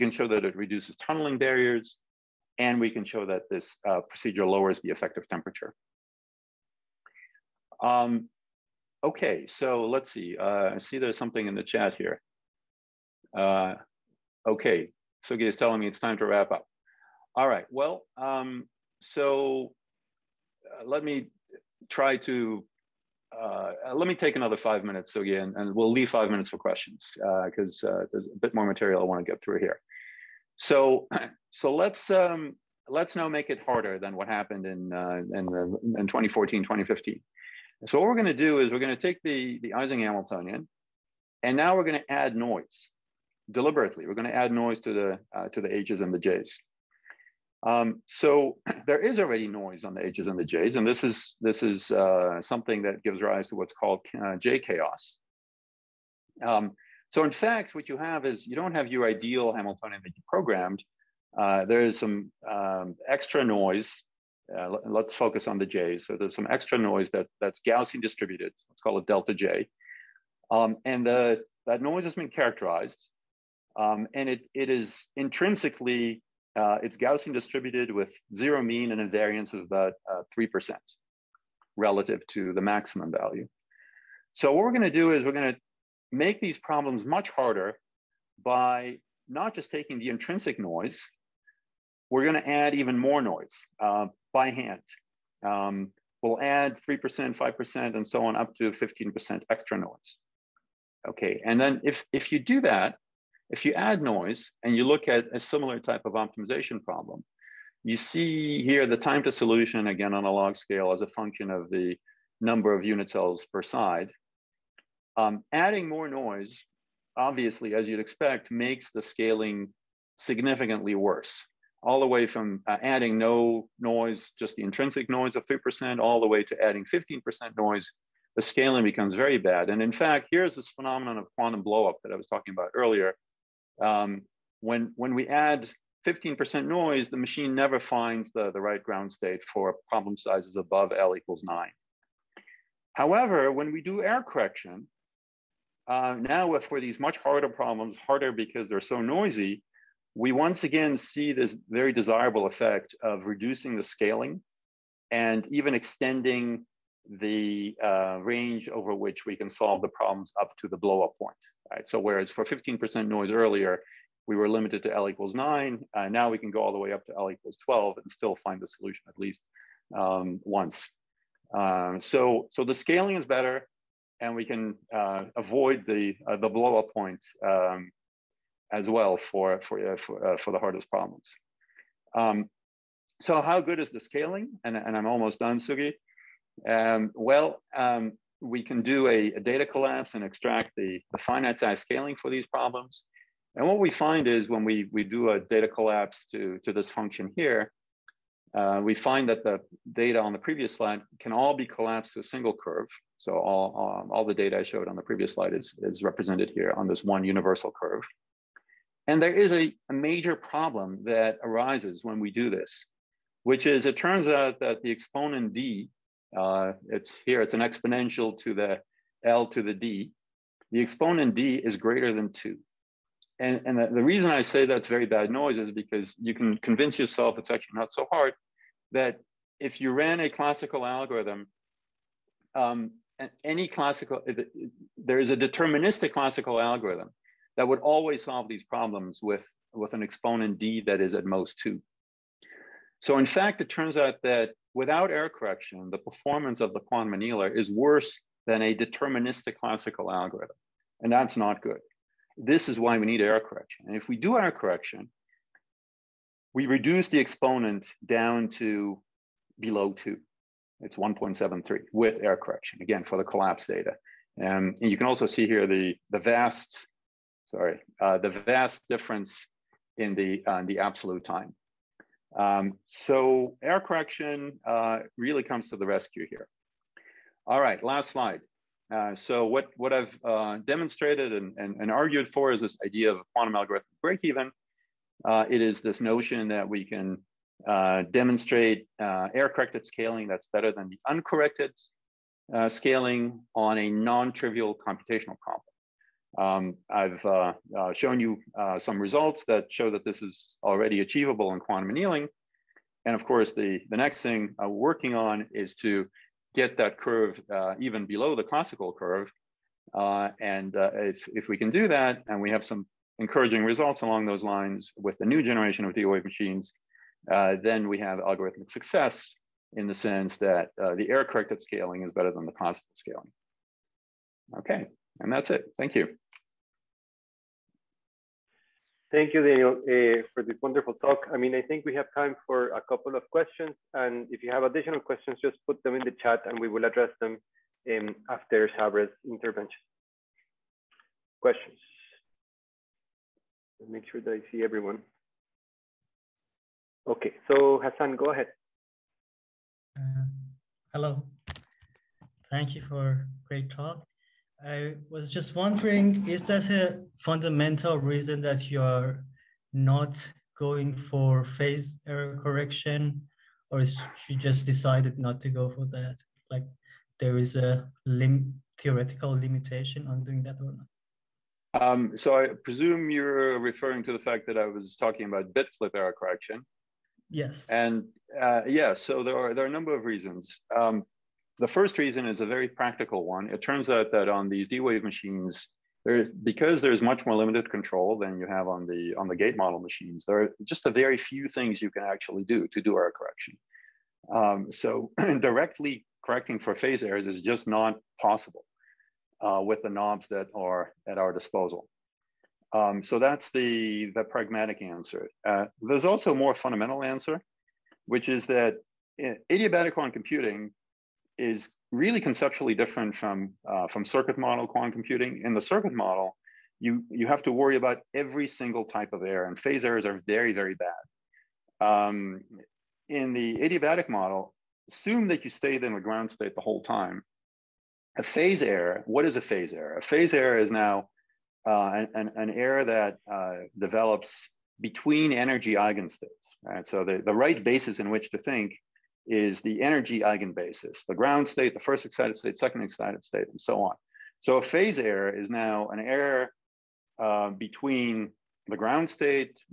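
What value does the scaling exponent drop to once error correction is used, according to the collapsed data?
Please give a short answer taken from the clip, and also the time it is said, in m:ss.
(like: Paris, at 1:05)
1.73, at 4:20.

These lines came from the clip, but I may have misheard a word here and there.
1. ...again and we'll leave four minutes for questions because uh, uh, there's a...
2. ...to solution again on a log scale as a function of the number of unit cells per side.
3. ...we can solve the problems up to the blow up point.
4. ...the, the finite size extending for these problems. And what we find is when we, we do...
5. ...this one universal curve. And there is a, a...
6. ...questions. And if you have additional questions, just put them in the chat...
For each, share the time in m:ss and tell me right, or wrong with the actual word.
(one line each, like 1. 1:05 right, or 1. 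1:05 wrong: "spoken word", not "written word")
1. 0:25 wrong: "five", not "four"
2. 1:49 right
3. 2:39 right
4. 3:10 wrong: "scaling", not "extending"
5. 3:26 right
6. 5:33 right.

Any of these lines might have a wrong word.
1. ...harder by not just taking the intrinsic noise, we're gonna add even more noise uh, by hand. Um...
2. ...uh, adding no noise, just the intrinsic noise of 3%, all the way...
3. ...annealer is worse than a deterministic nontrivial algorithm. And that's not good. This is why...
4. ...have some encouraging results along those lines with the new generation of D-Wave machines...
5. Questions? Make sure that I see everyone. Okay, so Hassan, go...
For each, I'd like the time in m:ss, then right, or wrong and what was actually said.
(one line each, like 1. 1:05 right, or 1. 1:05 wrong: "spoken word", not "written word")
1. 1:27 right
2. 2:02 right
3. 4:07 wrong: "classical", not "nontrivial"
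4. 5:12 right
5. 5:41 right.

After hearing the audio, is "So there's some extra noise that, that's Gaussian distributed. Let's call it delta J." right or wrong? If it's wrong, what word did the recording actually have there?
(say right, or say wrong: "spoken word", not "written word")
right.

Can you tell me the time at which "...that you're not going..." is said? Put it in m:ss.
5:58.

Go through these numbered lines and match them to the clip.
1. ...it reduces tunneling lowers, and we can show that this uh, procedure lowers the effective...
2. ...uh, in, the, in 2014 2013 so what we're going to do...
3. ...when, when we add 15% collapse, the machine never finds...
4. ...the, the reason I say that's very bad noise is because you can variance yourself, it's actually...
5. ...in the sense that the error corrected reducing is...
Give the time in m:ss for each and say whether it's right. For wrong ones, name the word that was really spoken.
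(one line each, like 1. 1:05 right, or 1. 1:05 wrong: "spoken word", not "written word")
1. 0:00 wrong: "barriers", not "lowers"
2. 0:34 wrong: "2015", not "2013"
3. 2:14 wrong: "noise", not "collapse"
4. 3:43 wrong: "convince", not "variance"
5. 5:19 wrong: "scaling", not "reducing".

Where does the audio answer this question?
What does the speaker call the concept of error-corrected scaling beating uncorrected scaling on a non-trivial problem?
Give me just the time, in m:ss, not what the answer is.
4:43.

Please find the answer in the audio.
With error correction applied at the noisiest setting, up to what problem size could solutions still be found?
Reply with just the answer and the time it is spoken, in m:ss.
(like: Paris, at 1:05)
L = 12, at 2:47.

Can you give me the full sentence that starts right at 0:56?
Um, so in fact, what you have is you don't have your ideal Hamiltonian that you programmed.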